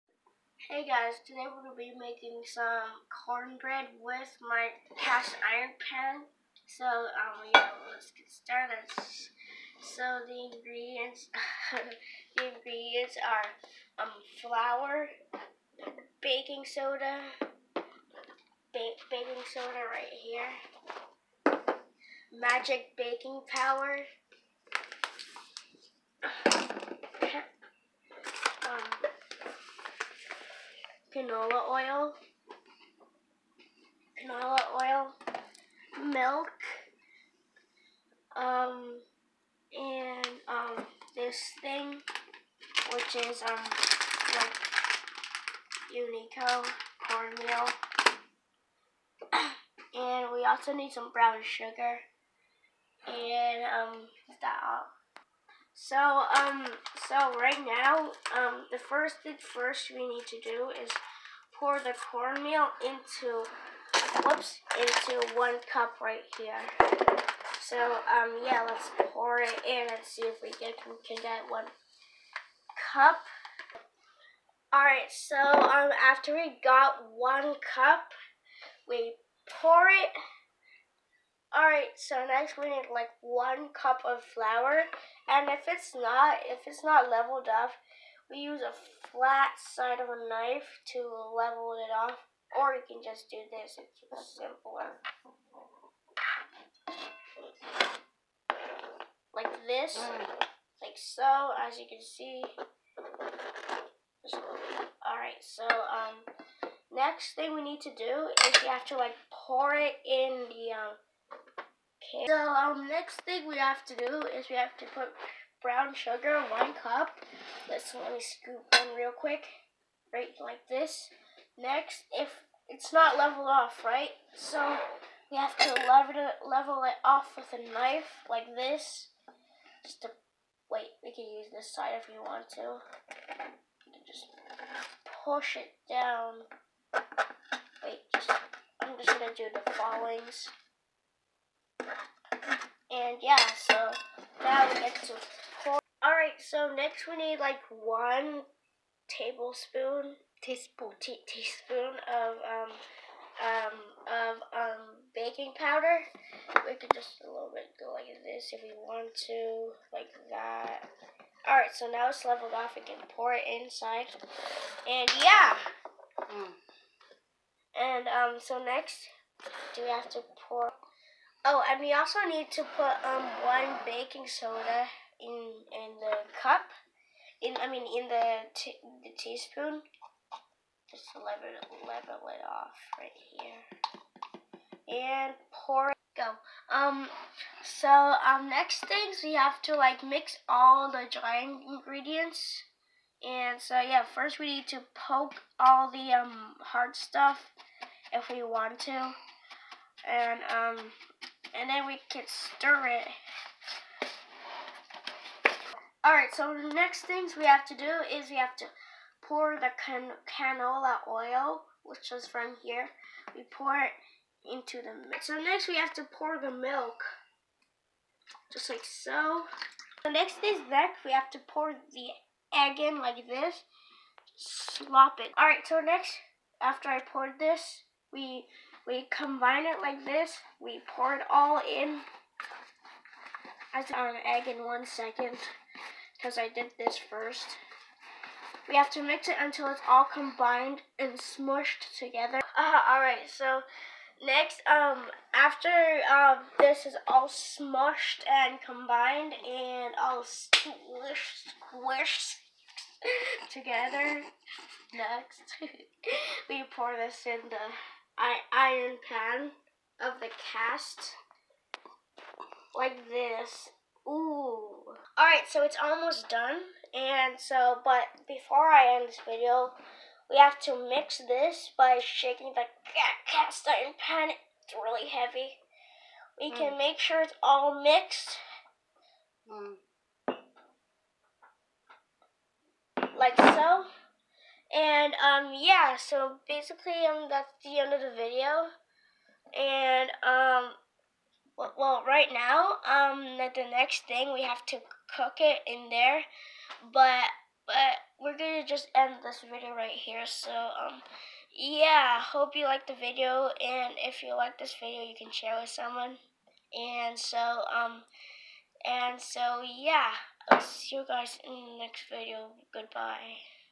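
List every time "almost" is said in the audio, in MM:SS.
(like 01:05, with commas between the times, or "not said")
04:25.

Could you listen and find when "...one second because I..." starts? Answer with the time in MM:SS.
03:54.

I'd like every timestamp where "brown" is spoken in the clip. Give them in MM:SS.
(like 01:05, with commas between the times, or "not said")
00:51, 01:55.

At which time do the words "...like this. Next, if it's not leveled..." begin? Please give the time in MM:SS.
02:00.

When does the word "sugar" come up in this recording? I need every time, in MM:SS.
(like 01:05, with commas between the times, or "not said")
00:51, 01:55.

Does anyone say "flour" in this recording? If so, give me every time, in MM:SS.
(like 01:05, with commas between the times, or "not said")
00:14, 01:24.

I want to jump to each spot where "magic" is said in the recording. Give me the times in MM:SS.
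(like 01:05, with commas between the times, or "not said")
00:22.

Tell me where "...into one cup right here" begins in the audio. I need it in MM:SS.
01:04.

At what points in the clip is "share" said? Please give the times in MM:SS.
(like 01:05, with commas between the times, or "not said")
05:05.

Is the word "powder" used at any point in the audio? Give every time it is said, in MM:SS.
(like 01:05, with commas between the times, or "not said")
00:23, 02:35.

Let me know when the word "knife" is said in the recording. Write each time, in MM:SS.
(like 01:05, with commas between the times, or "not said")
01:30, 02:07.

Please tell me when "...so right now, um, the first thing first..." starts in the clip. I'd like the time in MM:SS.
00:57.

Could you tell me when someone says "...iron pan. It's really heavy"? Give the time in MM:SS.
04:33.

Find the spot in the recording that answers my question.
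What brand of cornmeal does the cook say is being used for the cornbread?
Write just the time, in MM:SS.
00:45.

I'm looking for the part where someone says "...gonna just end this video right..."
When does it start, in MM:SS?
04:58.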